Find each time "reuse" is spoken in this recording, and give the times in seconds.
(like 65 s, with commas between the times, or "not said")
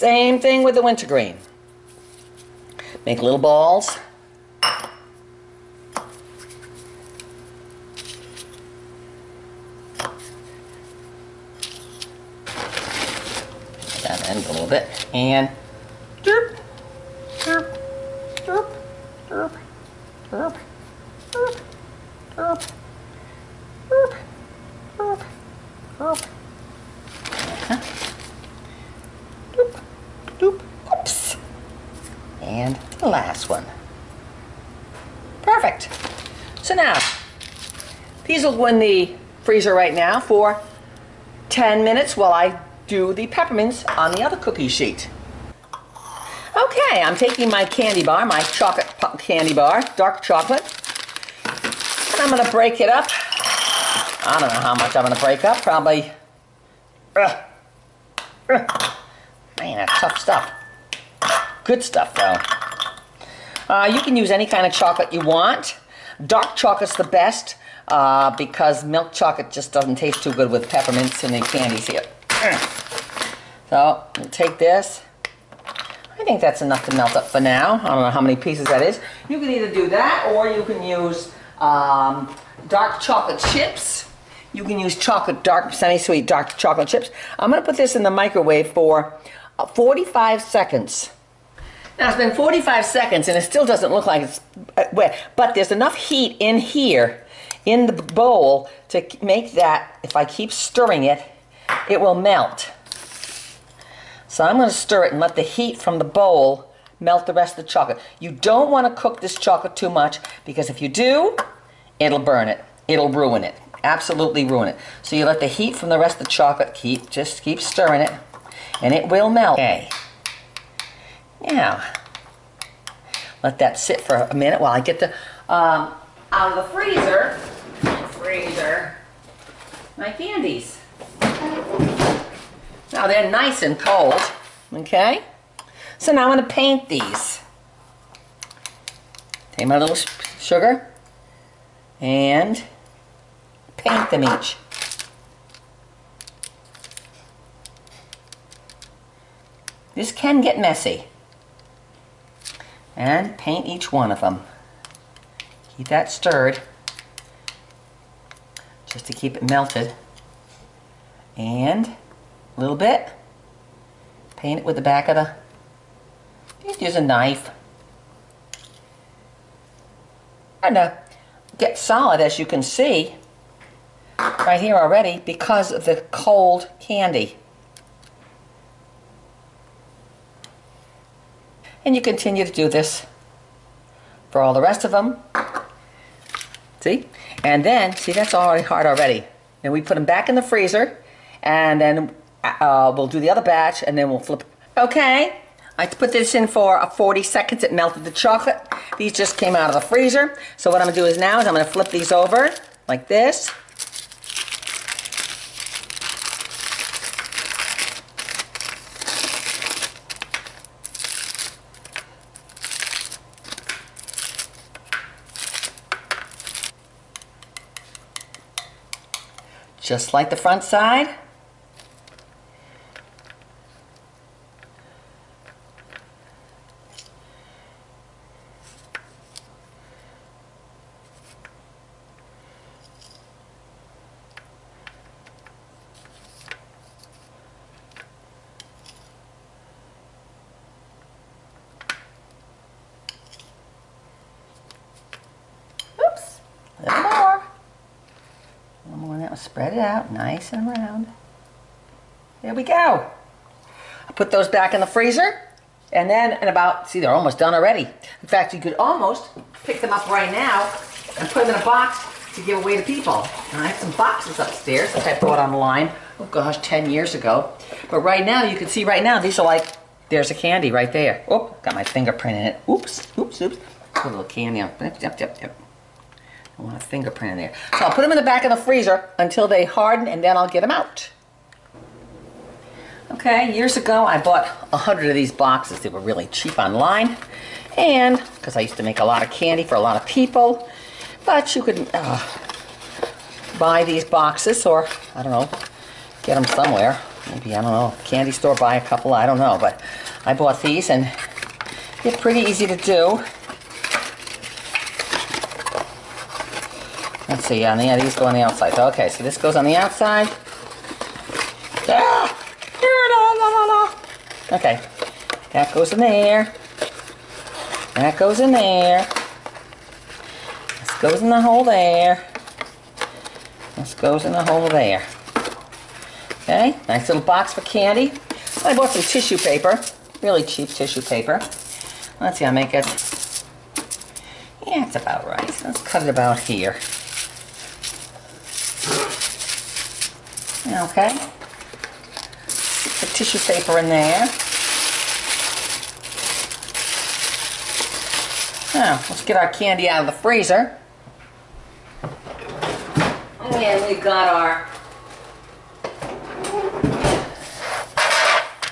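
not said.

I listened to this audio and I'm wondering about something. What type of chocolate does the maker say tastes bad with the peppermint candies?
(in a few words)
milk chocolate.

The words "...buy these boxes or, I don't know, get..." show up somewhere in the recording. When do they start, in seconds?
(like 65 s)
293 s.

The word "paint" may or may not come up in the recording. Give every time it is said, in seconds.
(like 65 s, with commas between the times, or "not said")
136 s, 143 s, 153 s, 164 s.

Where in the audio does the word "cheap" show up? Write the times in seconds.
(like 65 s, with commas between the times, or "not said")
286 s, 330 s.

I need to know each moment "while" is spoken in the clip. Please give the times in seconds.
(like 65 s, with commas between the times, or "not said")
42 s, 124 s.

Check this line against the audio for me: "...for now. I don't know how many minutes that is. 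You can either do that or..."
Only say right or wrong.
wrong.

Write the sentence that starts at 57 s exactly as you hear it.
Uh, uh, man, that's tough stuff.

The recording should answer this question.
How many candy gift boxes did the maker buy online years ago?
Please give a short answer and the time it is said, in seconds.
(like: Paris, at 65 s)
100, at 284 s.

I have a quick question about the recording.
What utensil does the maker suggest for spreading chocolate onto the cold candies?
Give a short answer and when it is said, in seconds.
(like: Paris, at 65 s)
knife, at 167 s.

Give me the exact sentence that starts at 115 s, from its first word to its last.
So you let the heat from the rest of the chocolate keep, just keep stirring it and it will melt.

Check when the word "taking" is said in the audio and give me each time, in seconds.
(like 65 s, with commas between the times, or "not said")
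47 s.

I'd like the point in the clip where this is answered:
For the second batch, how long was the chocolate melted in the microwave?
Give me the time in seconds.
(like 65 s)
196 s.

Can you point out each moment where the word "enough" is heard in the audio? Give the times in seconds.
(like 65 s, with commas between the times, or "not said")
76 s, 95 s.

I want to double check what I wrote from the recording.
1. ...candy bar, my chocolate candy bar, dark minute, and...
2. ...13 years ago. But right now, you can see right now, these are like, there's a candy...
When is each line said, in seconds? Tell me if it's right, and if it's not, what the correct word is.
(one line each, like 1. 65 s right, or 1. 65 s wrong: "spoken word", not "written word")
1. 47 s wrong: "chocolate", not "minute"
2. 266 s wrong: "10", not "13".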